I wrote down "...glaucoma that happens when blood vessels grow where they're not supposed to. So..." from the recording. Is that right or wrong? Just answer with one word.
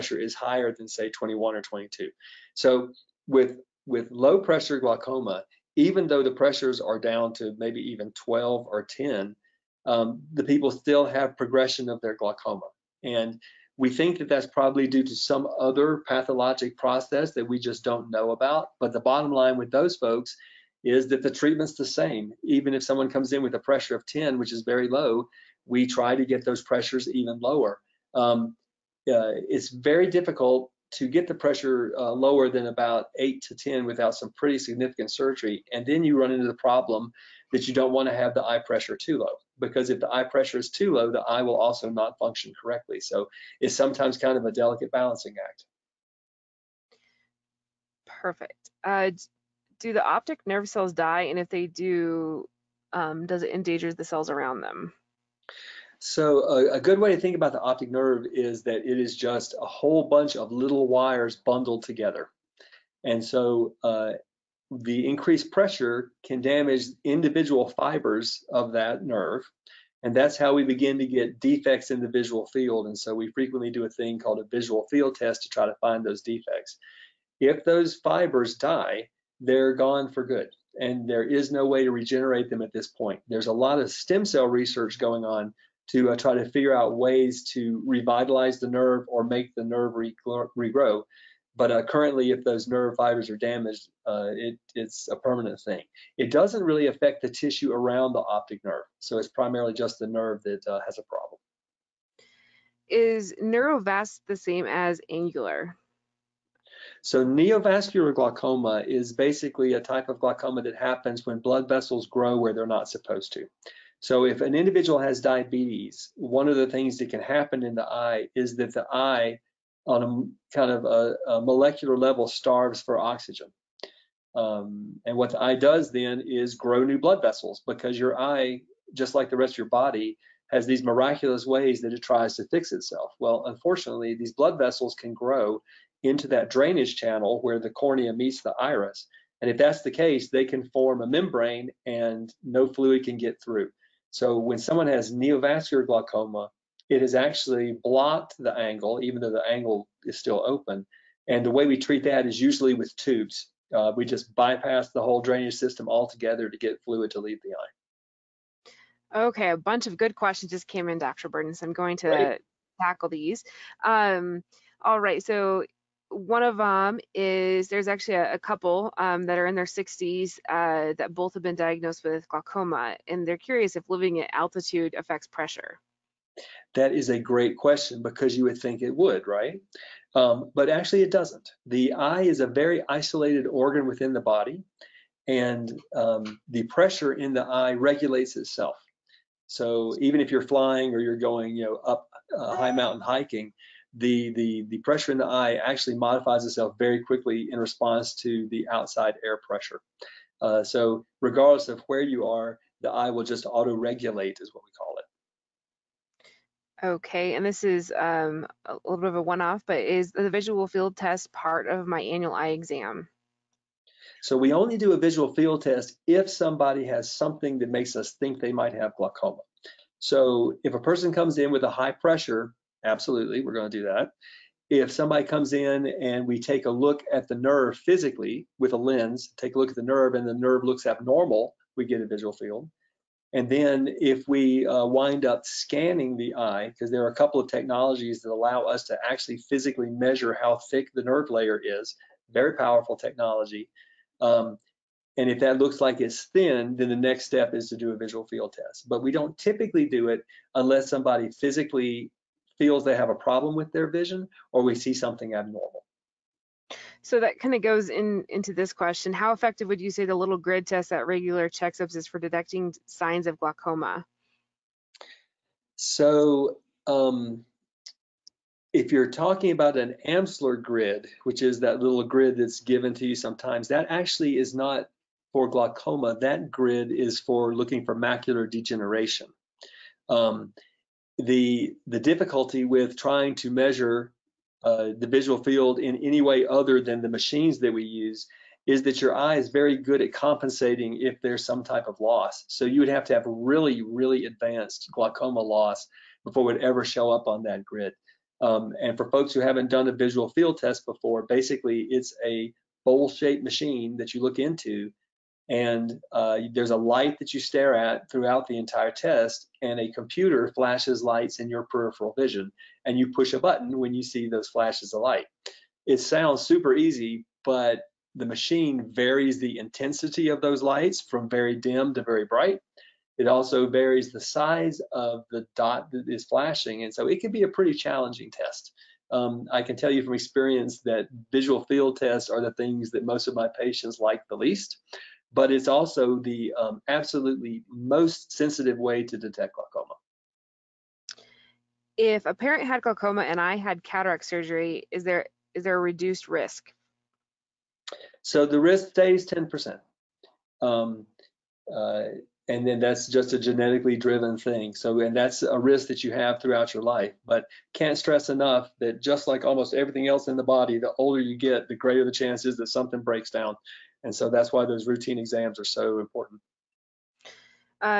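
right.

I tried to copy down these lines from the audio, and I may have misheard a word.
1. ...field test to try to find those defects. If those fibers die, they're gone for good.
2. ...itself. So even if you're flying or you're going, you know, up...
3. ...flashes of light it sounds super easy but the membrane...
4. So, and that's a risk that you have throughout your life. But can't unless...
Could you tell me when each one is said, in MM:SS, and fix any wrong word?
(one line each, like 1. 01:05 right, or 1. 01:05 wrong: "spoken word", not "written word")
1. 01:14 right
2. 03:08 right
3. 05:14 wrong: "machine", not "membrane"
4. 05:54 wrong: "stress", not "unless".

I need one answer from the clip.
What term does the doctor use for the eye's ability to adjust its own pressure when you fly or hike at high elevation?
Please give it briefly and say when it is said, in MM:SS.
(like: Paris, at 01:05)
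auto-regulate, at 03:23.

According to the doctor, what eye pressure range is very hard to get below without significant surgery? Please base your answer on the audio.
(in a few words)
8 to 10.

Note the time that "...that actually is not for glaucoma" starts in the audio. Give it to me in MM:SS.
04:33.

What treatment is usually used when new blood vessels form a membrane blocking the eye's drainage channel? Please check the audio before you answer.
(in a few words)
tubes.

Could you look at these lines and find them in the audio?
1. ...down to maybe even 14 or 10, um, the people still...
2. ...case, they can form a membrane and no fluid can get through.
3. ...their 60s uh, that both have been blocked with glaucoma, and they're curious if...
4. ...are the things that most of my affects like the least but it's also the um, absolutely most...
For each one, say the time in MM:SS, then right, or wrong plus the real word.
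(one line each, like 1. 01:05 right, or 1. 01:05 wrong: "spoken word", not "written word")
1. 00:06 wrong: "12", not "14"
2. 02:19 right
3. 02:49 wrong: "diagnosed", not "blocked"
4. 05:32 wrong: "patients", not "affects".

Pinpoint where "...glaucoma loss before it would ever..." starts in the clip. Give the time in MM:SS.
04:54.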